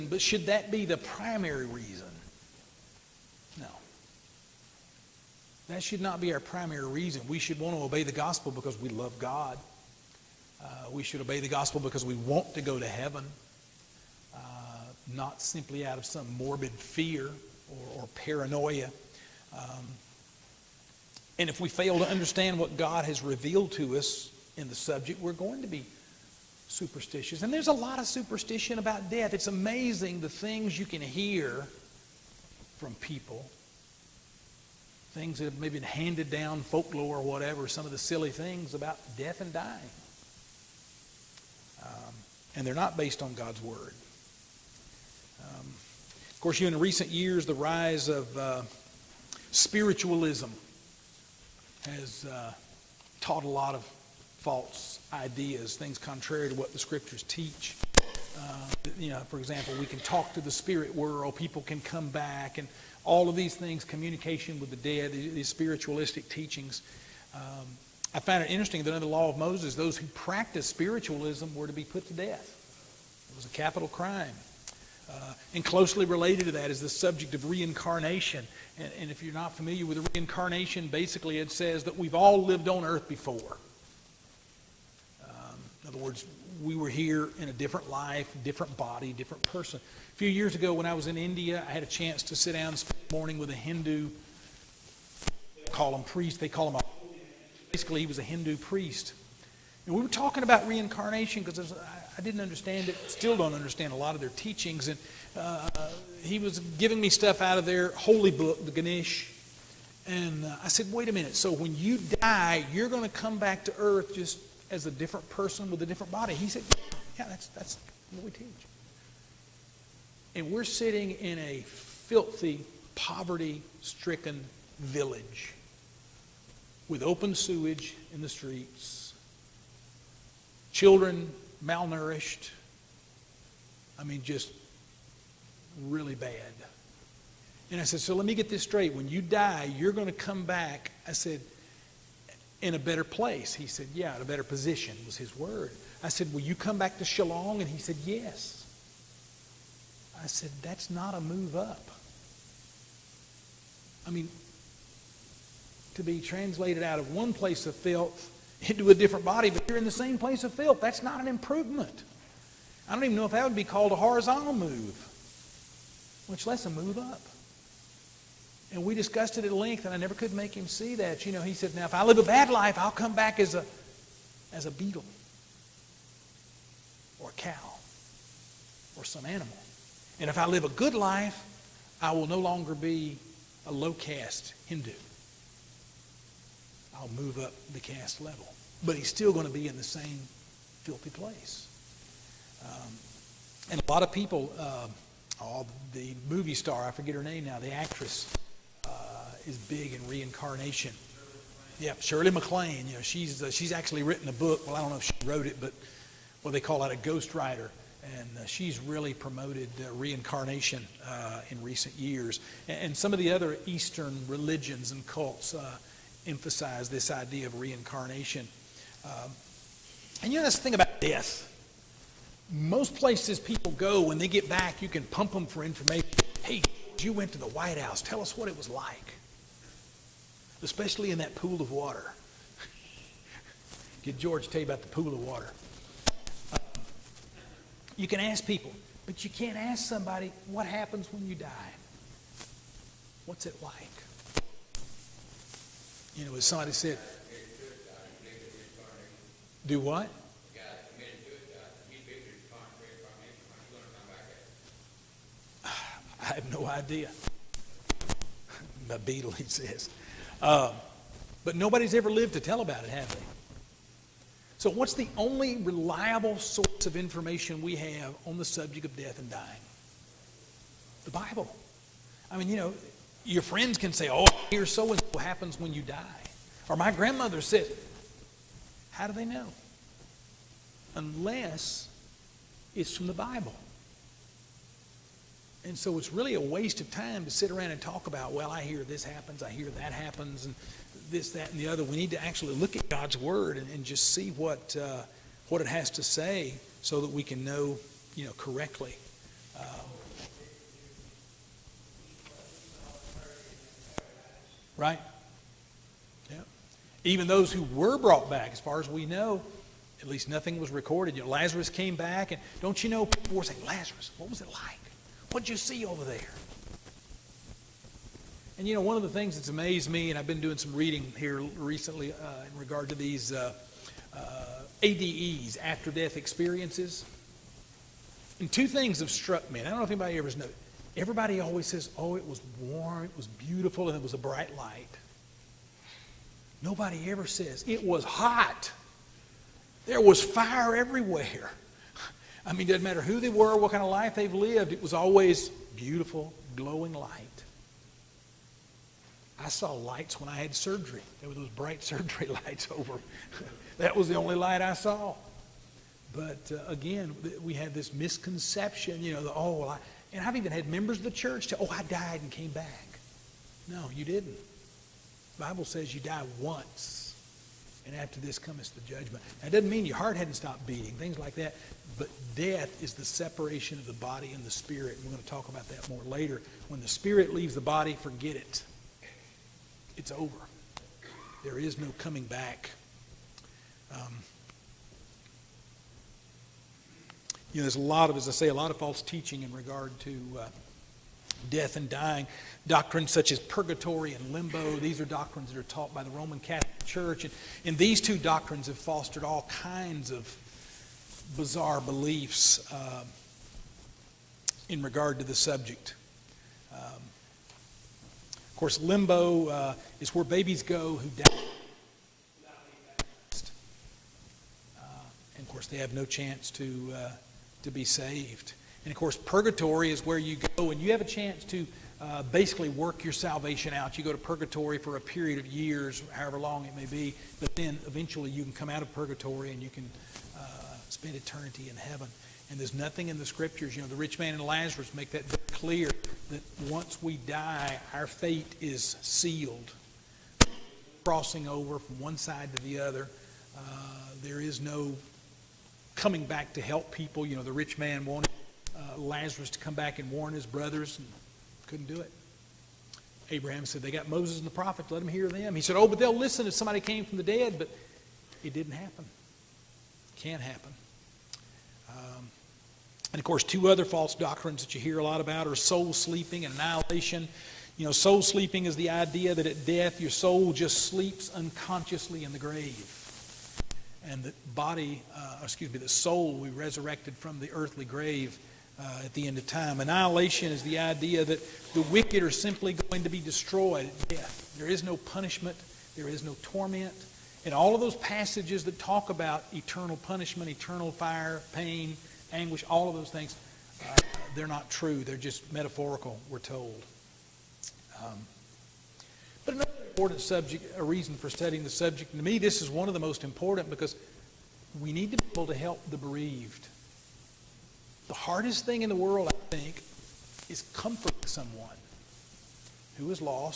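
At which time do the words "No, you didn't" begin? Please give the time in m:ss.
6:03.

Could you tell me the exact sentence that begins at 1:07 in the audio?
Um, I found it interesting that under the law of Moses, those who practiced spiritualism were to be put to death.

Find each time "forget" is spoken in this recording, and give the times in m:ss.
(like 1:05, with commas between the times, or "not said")
3:16, 6:17.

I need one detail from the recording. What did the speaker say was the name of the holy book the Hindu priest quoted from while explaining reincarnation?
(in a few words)
The Ganesh.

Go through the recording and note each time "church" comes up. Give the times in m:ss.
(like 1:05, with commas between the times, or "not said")
6:01, 6:36.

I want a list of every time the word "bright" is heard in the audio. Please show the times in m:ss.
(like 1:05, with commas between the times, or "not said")
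5:34, 5:51.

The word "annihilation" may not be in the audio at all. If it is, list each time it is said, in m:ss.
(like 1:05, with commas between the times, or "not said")
7:46, 7:59.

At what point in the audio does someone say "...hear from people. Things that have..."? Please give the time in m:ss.
0:30.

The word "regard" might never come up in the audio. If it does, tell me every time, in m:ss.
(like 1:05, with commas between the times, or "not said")
5:22, 6:29, 6:44.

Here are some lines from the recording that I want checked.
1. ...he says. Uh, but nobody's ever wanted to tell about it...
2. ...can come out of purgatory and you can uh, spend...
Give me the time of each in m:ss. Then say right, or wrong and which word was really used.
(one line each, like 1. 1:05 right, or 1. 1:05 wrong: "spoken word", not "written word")
1. 4:19 wrong: "lived", not "wanted"
2. 7:08 right.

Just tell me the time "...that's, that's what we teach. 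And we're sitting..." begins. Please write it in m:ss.
1:57.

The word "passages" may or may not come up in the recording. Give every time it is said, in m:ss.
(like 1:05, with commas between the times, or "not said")
8:07.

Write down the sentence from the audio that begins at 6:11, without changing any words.
But death is the separation of the body and the spirit.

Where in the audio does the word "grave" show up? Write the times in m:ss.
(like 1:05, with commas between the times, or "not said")
7:52, 7:57.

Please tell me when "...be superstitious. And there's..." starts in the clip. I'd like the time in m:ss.
0:25.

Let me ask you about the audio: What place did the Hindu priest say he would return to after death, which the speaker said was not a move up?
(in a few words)
Shillong.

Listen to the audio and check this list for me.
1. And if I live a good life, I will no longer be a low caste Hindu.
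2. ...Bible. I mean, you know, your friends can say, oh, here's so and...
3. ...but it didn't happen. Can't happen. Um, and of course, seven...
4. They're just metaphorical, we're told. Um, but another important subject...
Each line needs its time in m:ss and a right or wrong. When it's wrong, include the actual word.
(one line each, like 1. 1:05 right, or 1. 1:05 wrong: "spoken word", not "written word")
1. 3:00 right
2. 4:31 right
3. 7:37 wrong: "two", not "seven"
4. 8:15 right.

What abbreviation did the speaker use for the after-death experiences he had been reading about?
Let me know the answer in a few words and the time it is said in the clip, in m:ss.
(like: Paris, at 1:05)
ADEs, at 5:24.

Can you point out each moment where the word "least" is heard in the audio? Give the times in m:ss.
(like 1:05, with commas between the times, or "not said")
5:10.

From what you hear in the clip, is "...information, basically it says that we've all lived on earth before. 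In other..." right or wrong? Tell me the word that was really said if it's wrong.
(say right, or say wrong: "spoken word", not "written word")
wrong: "reincarnation", not "information".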